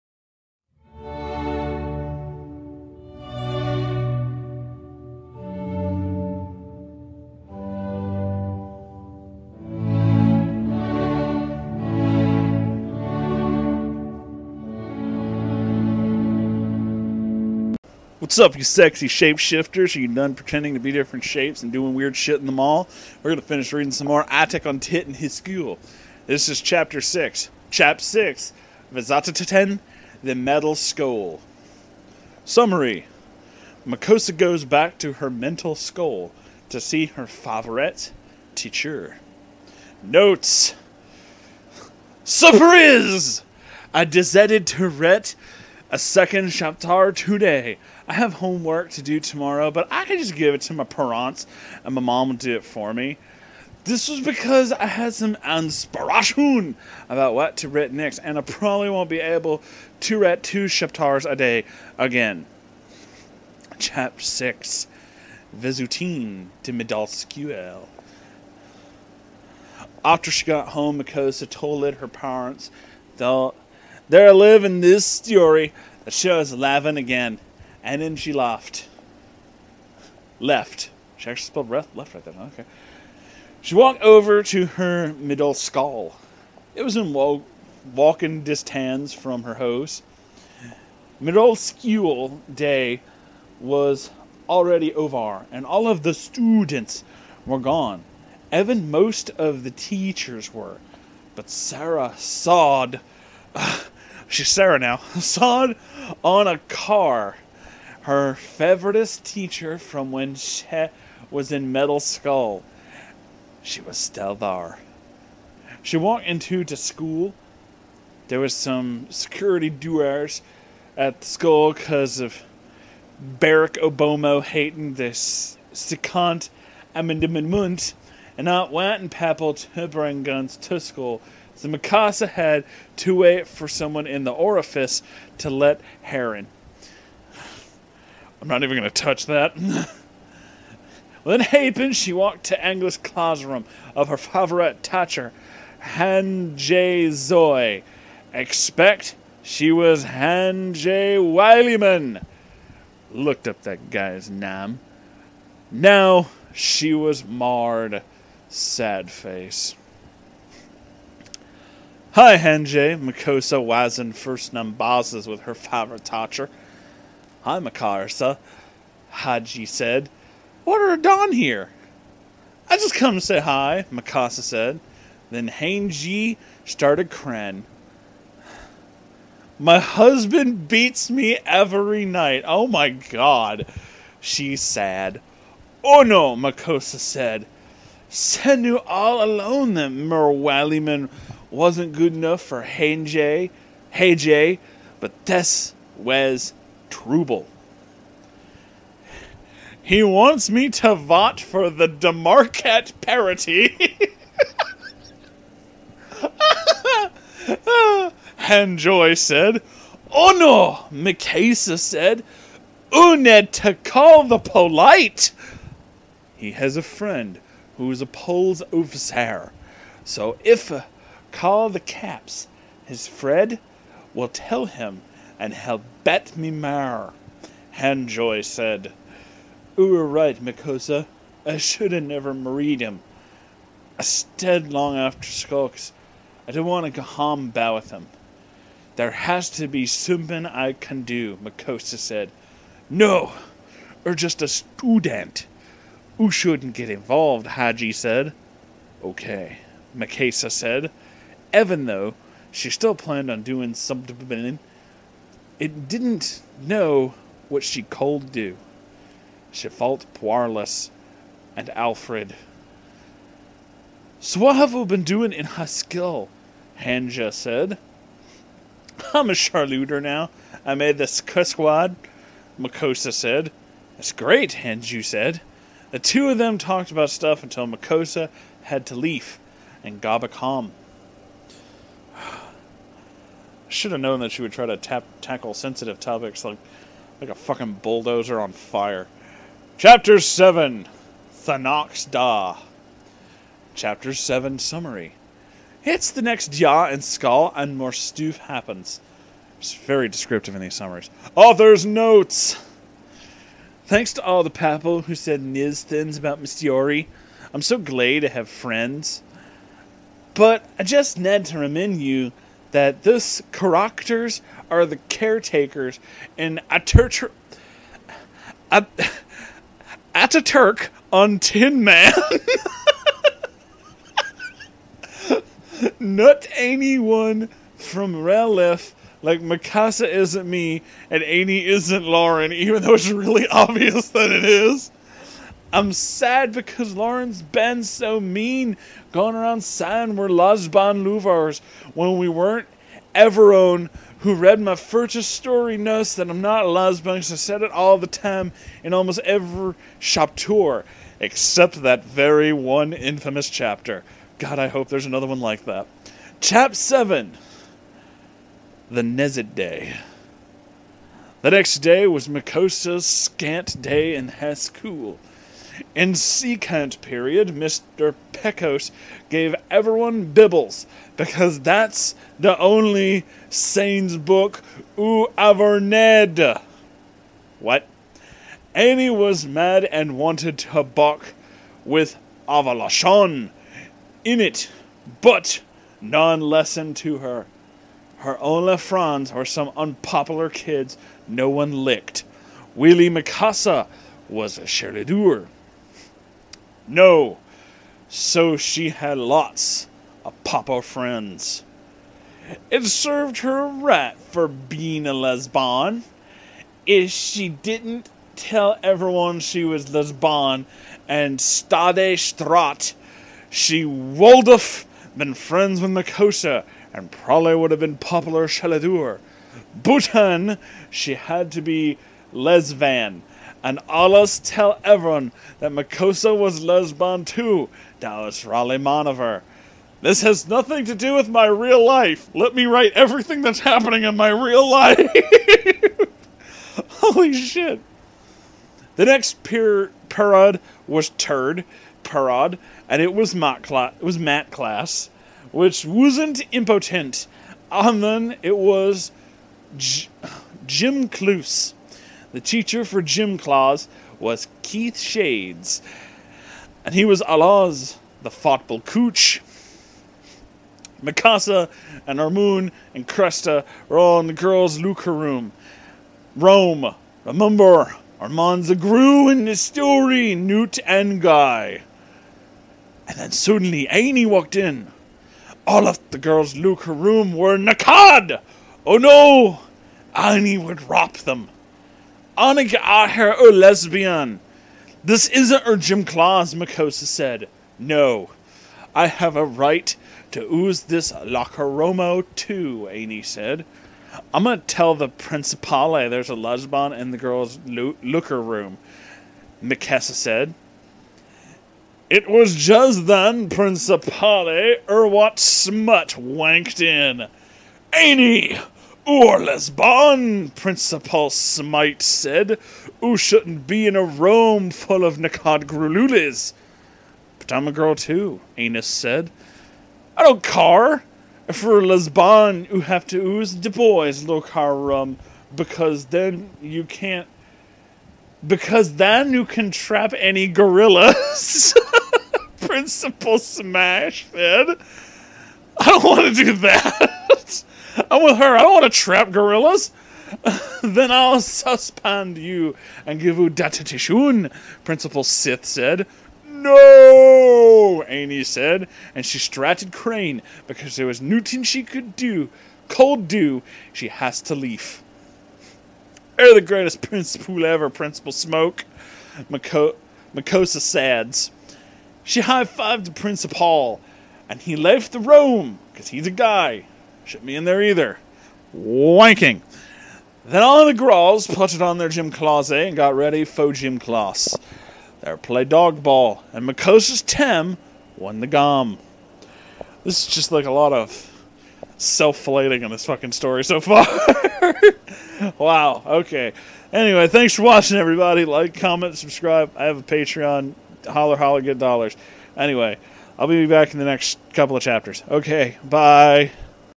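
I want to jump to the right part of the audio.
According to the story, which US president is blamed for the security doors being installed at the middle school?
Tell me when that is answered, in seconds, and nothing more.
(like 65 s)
123 s.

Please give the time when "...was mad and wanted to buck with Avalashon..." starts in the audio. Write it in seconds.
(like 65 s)
379 s.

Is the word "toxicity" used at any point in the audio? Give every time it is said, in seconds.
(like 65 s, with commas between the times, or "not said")
not said.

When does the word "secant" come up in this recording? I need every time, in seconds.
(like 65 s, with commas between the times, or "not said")
125 s, 366 s.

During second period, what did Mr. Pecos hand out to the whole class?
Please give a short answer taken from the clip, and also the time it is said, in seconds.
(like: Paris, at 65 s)
Bibles, at 370 s.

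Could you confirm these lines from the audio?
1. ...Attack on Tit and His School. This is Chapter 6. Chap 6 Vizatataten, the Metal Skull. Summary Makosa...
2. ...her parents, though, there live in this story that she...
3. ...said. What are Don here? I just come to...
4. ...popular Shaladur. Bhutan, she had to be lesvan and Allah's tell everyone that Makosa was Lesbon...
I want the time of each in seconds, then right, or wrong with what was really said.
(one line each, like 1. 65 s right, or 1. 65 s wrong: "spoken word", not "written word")
1. 24 s right
2. 71 s right
3. 169 s right
4. 417 s right.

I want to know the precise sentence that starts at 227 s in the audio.
Hanjoy said, "Oo were right, Makosa.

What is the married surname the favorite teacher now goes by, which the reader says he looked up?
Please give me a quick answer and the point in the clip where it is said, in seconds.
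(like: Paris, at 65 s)
Wileyman, at 151 s.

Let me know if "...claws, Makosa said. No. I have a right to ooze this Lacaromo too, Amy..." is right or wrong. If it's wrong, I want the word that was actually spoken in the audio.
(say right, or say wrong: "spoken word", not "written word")
right.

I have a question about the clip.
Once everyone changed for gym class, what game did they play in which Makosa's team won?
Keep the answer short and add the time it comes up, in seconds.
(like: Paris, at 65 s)
dog ball, at 575 s.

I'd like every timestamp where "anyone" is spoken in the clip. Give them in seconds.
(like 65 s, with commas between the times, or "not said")
326 s.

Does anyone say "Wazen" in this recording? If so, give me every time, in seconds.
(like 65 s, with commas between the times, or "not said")
163 s.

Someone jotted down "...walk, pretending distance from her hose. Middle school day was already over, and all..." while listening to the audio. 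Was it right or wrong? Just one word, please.
wrong.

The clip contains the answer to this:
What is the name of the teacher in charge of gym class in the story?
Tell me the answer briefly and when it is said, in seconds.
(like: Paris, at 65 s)
Keith Shades, at 454 s.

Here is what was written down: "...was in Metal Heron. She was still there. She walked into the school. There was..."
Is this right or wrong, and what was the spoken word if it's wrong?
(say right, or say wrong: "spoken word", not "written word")
wrong: "Skull", not "Heron".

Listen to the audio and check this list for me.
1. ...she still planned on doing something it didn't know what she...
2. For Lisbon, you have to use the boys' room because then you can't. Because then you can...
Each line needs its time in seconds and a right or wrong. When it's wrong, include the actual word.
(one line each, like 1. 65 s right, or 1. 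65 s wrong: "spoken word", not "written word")
1. 252 s right
2. 521 s right.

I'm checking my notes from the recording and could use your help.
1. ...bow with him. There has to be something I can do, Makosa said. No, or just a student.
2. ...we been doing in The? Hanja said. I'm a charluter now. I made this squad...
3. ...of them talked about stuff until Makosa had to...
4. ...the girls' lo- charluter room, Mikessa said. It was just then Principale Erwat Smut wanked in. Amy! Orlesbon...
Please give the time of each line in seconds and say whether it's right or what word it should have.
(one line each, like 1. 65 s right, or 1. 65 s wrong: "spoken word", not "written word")
1. 237 s right
2. 264 s wrong: "Haskell", not "The"
3. 276 s right
4. 497 s wrong: "looker", not "charluter".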